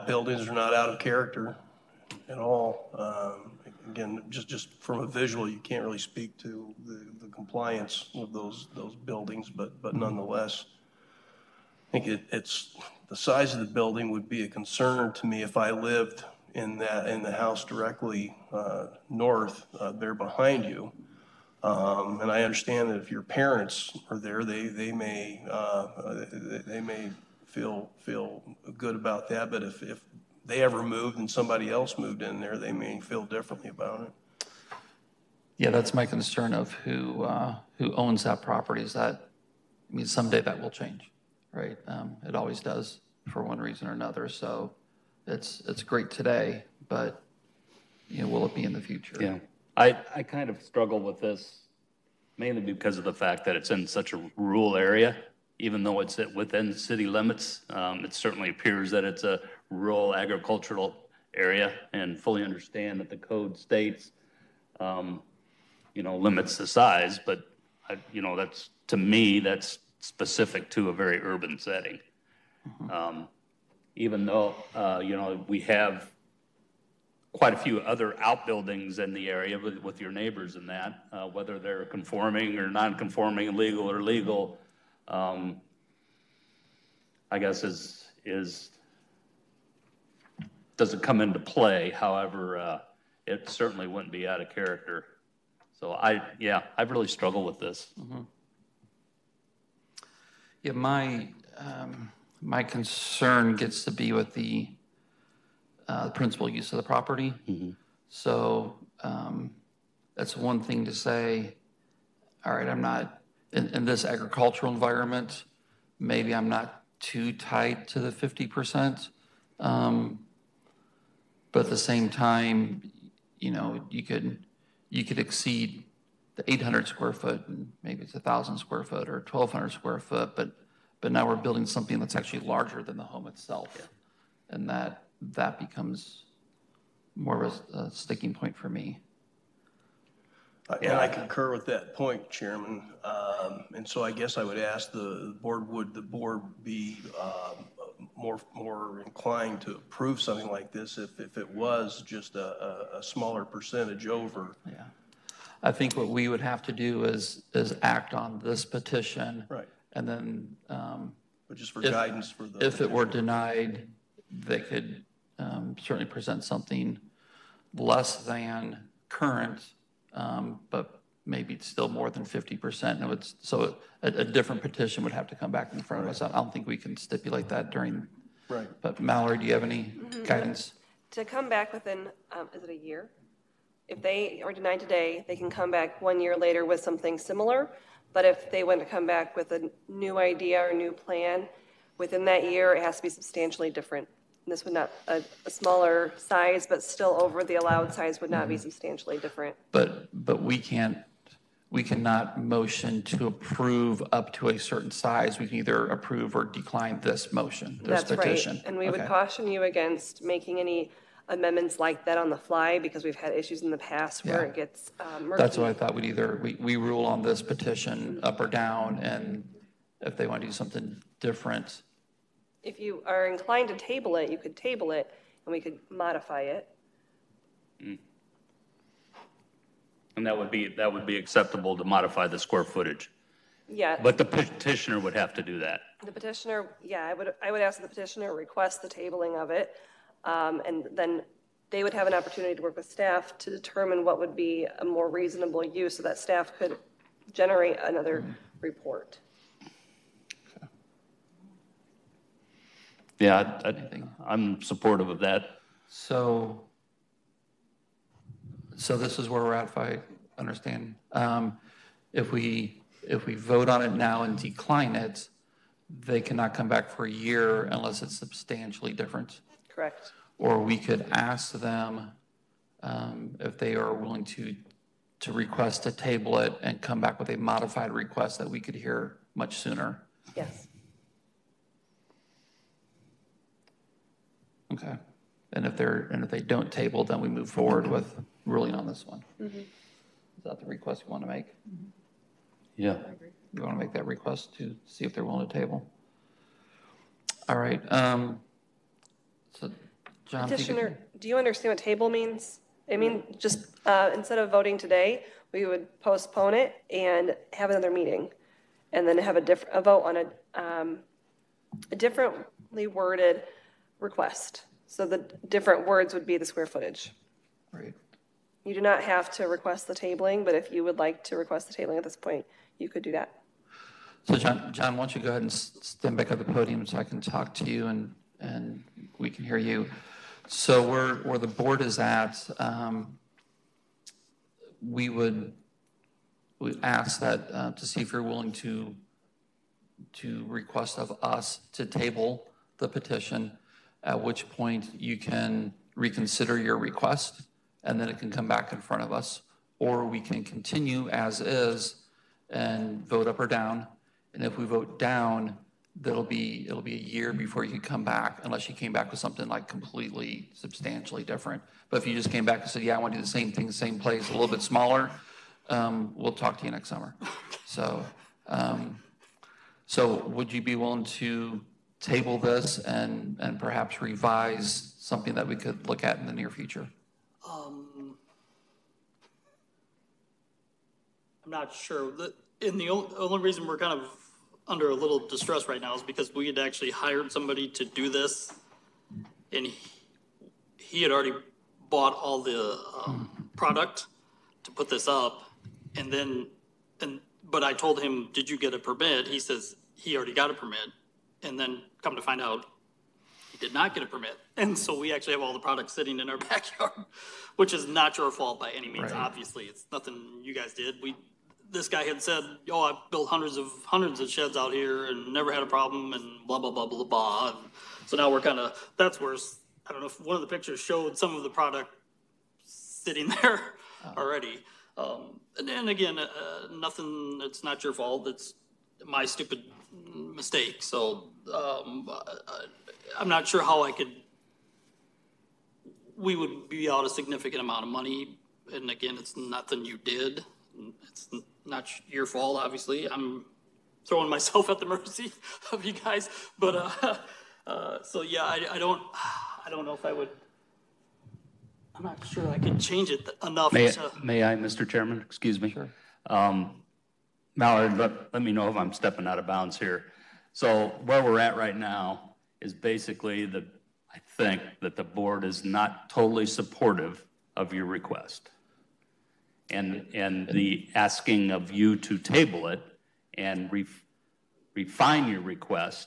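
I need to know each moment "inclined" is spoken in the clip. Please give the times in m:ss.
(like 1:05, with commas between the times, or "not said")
2:29, 3:43.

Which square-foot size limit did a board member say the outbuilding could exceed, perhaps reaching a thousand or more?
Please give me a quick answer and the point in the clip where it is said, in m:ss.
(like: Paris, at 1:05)
800 square foot, at 2:06.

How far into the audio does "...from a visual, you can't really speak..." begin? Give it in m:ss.
0:04.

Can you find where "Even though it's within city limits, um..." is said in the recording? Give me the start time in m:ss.
0:55.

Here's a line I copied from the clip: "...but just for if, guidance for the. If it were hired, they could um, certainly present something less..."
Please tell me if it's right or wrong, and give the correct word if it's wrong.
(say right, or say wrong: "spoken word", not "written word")
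wrong: "denied", not "hired".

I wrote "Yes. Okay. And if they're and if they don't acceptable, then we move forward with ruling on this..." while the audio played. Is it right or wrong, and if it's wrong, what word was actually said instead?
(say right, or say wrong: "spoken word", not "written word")
wrong: "table", not "acceptable".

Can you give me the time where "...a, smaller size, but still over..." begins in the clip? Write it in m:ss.
3:15.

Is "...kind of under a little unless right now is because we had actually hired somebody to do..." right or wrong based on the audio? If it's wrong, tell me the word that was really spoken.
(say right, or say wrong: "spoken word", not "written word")
wrong: "distress", not "unless".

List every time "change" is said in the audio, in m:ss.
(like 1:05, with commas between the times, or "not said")
0:40, 7:32.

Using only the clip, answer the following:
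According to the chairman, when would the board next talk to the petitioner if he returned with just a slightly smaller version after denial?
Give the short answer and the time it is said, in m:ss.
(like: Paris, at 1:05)
next summer, at 6:06.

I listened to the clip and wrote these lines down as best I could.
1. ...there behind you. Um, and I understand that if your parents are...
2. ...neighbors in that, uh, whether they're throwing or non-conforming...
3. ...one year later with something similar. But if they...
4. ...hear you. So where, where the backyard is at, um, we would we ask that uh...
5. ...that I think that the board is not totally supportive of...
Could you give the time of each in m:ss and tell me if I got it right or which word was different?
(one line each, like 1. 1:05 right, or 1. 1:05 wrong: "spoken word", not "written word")
1. 0:19 right
2. 1:20 wrong: "conforming", not "throwing"
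3. 3:06 right
4. 5:29 wrong: "board", not "backyard"
5. 7:43 right.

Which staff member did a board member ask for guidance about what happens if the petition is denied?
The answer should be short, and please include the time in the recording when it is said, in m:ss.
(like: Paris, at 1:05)
Mallory, at 2:59.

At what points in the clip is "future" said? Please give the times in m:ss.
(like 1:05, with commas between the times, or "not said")
0:48, 6:16.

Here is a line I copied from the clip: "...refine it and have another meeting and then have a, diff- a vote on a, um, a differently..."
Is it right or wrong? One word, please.
wrong.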